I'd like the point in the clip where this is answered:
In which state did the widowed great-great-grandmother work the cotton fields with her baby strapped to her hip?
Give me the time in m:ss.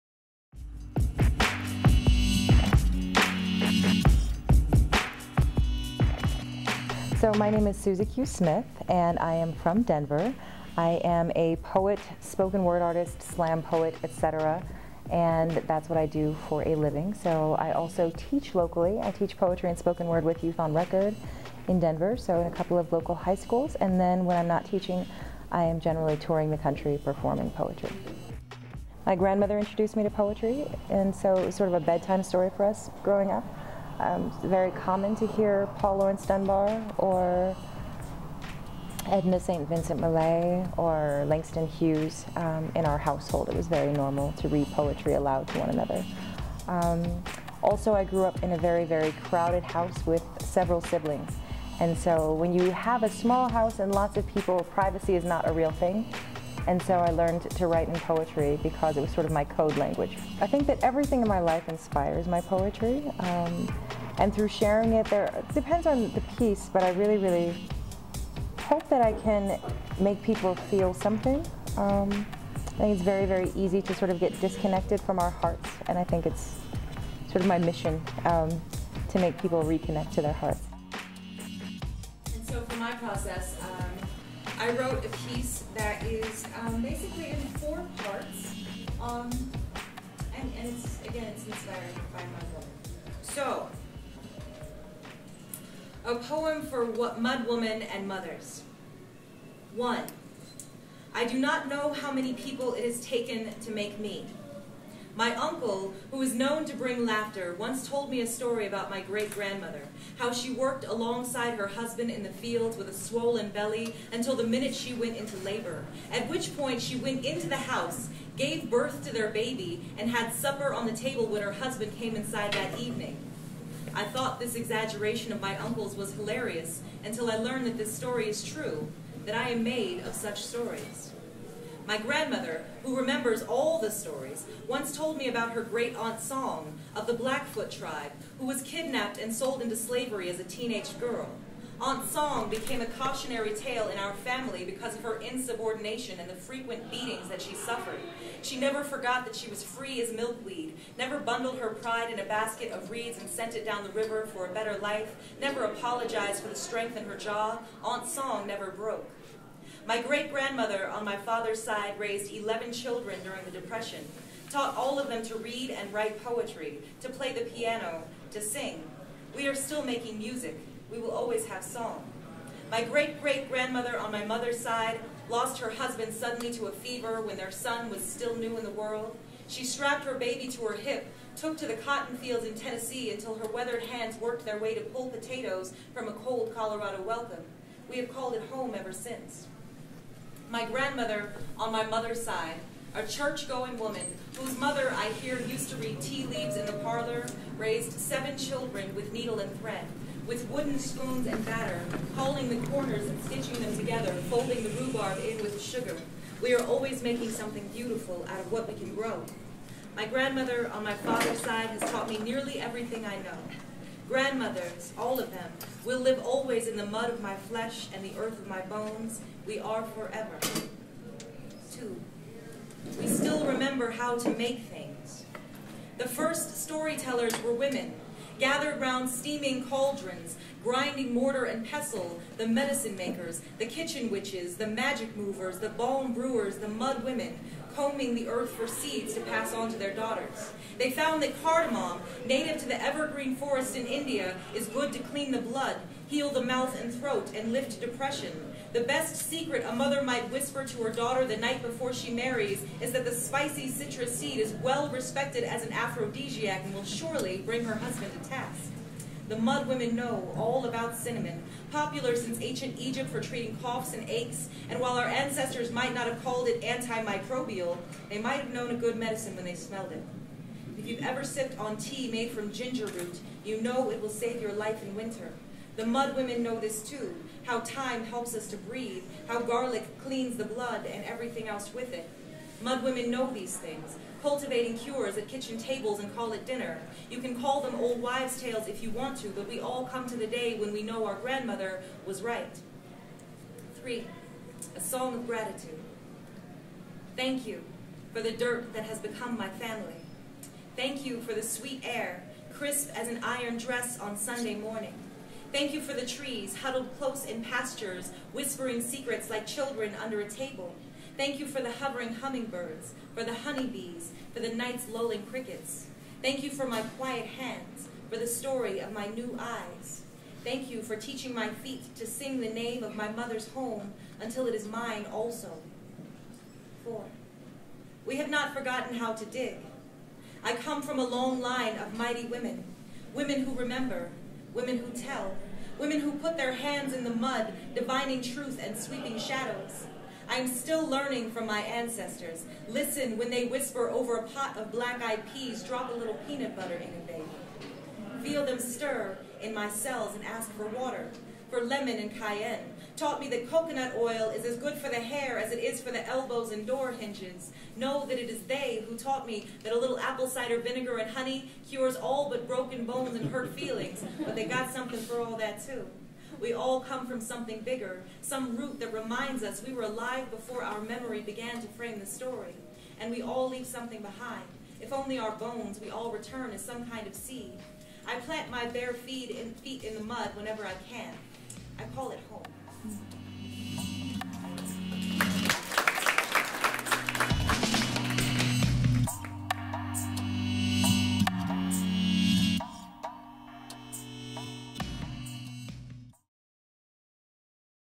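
3:02.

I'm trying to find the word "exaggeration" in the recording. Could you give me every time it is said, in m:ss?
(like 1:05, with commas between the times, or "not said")
2:04.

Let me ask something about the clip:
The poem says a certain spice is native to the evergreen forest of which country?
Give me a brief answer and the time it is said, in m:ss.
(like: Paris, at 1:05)
India, at 4:03.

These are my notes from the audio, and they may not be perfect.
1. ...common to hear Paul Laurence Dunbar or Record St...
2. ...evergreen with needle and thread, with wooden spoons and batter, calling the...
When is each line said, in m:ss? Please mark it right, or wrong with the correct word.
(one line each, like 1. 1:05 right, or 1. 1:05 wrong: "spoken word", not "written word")
1. 0:34 wrong: "Edna", not "Record"
2. 3:18 wrong: "children", not "evergreen".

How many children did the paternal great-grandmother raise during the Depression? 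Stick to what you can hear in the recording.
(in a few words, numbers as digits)
11.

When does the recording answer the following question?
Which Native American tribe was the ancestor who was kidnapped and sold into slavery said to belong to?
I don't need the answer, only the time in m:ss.
2:17.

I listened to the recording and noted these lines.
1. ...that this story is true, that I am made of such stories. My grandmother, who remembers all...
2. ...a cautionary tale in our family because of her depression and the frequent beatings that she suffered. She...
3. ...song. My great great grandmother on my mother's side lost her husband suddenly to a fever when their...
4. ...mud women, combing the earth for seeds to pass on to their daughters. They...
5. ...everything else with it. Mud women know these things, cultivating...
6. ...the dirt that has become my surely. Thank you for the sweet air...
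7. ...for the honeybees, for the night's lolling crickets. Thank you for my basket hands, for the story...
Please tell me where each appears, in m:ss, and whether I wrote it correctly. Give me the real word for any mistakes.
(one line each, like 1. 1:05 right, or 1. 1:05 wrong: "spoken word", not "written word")
1. 2:07 right
2. 2:22 wrong: "insubordination", not "depression"
3. 2:51 right
4. 3:56 right
5. 4:41 right
6. 4:58 wrong: "family", not "surely"
7. 5:13 wrong: "quiet", not "basket".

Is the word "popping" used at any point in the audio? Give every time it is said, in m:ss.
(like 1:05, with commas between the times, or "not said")
not said.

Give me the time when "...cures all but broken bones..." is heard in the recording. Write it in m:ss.
6:01.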